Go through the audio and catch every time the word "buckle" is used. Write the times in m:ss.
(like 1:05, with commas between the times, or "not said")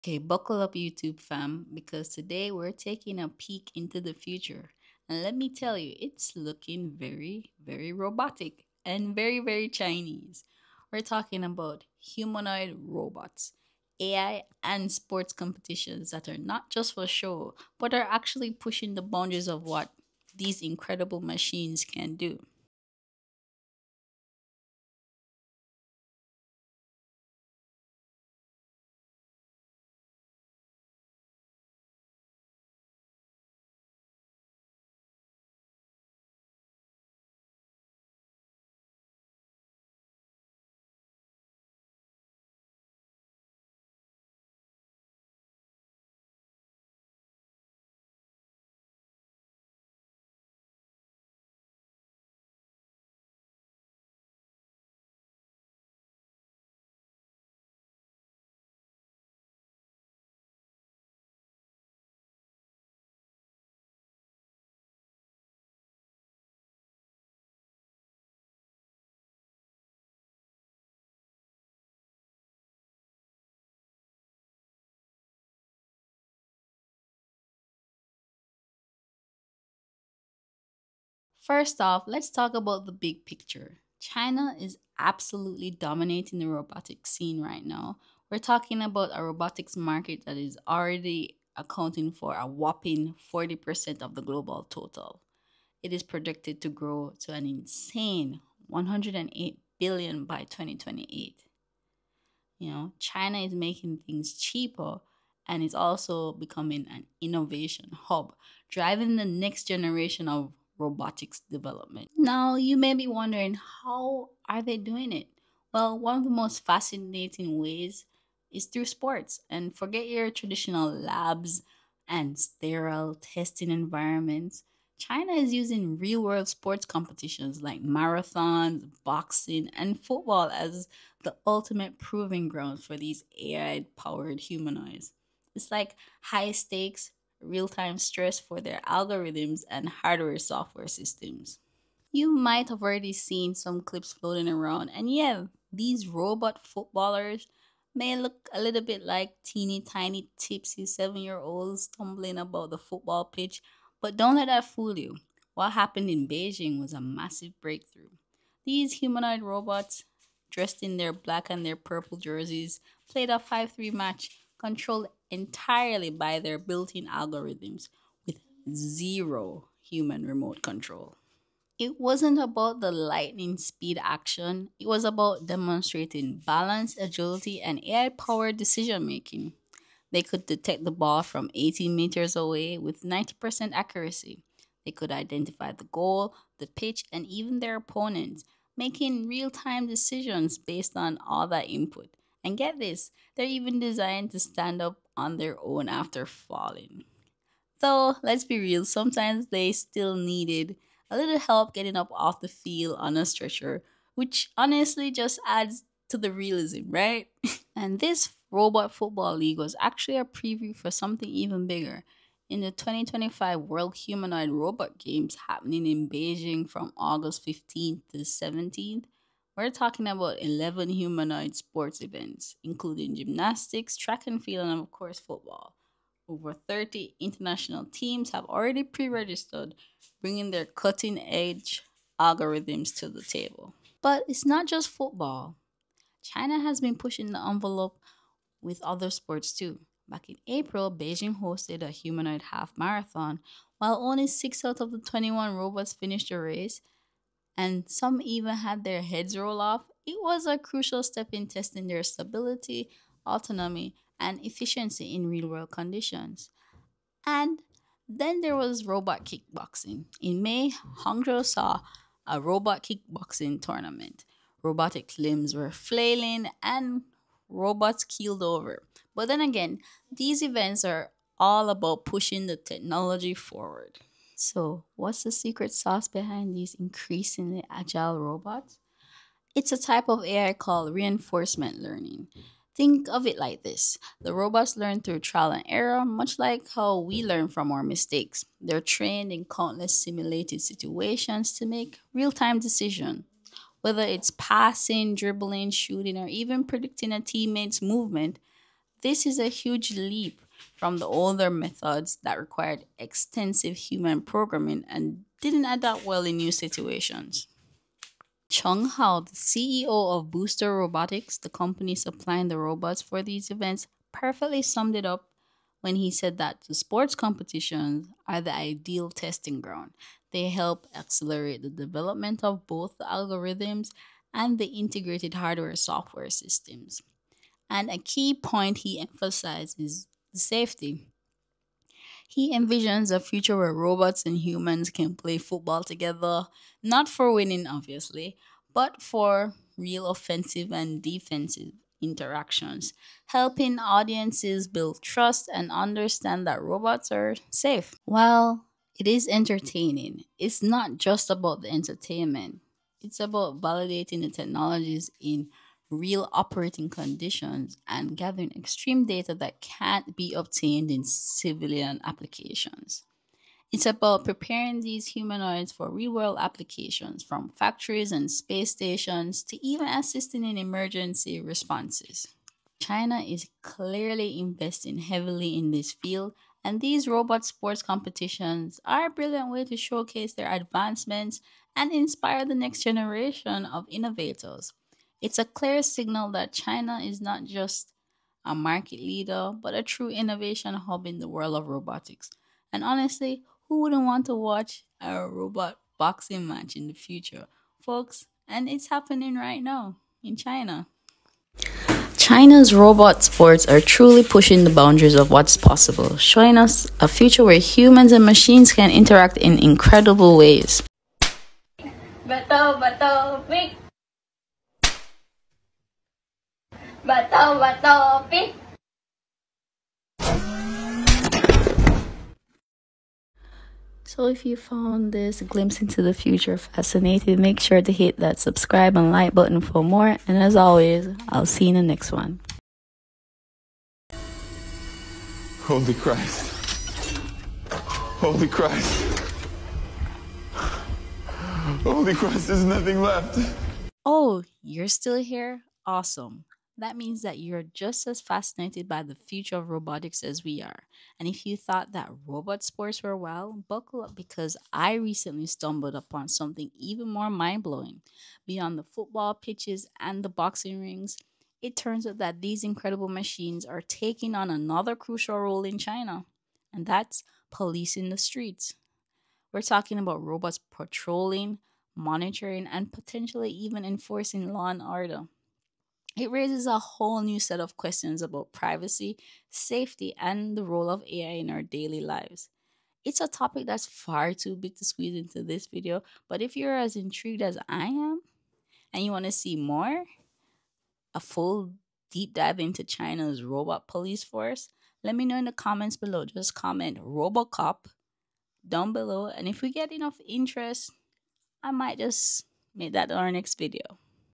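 0:00, 7:33.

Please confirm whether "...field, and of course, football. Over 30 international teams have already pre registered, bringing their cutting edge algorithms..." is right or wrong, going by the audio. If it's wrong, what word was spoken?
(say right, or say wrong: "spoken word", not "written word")
right.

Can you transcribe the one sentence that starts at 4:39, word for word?
It's a type of AI called reinforcement learning.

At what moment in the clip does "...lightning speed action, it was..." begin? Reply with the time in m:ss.
2:52.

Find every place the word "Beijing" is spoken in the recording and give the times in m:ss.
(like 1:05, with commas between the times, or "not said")
2:36, 3:36, 4:00.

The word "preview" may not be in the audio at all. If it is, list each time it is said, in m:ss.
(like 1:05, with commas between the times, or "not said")
3:30.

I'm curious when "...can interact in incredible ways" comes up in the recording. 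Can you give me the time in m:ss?
6:48.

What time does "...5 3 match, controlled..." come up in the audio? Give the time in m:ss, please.
2:43.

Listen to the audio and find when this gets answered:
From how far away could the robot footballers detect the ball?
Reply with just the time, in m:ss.
3:01.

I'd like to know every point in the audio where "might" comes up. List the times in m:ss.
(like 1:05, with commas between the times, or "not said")
2:22, 8:21.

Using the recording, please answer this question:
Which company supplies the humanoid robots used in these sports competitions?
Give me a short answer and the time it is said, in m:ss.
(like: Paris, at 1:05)
Booster Robotics, at 5:10.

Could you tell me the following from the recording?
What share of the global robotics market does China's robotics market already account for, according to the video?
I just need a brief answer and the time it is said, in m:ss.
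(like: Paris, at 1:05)
40%, at 1:33.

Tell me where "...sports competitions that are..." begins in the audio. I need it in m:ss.
0:14.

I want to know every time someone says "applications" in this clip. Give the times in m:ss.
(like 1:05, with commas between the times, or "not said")
6:02, 6:06.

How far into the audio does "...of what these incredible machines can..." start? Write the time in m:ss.
0:19.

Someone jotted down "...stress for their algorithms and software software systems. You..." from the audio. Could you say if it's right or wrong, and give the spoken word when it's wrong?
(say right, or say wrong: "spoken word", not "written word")
wrong: "hardware", not "software".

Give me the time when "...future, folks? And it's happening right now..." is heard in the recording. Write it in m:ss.
6:36.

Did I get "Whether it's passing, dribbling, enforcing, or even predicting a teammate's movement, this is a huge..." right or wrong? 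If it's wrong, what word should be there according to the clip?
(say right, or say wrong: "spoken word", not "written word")
wrong: "shooting", not "enforcing".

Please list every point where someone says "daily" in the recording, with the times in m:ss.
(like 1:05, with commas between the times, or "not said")
8:01.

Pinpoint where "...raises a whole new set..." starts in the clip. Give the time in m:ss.
7:56.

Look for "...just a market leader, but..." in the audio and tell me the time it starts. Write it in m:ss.
6:27.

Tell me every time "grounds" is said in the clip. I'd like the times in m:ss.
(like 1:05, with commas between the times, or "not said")
2:12, 5:19.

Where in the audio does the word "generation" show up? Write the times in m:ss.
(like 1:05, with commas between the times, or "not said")
1:49, 6:22.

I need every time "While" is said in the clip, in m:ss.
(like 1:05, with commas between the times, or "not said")
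4:03, 5:48.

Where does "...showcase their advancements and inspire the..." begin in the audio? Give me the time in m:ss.
6:19.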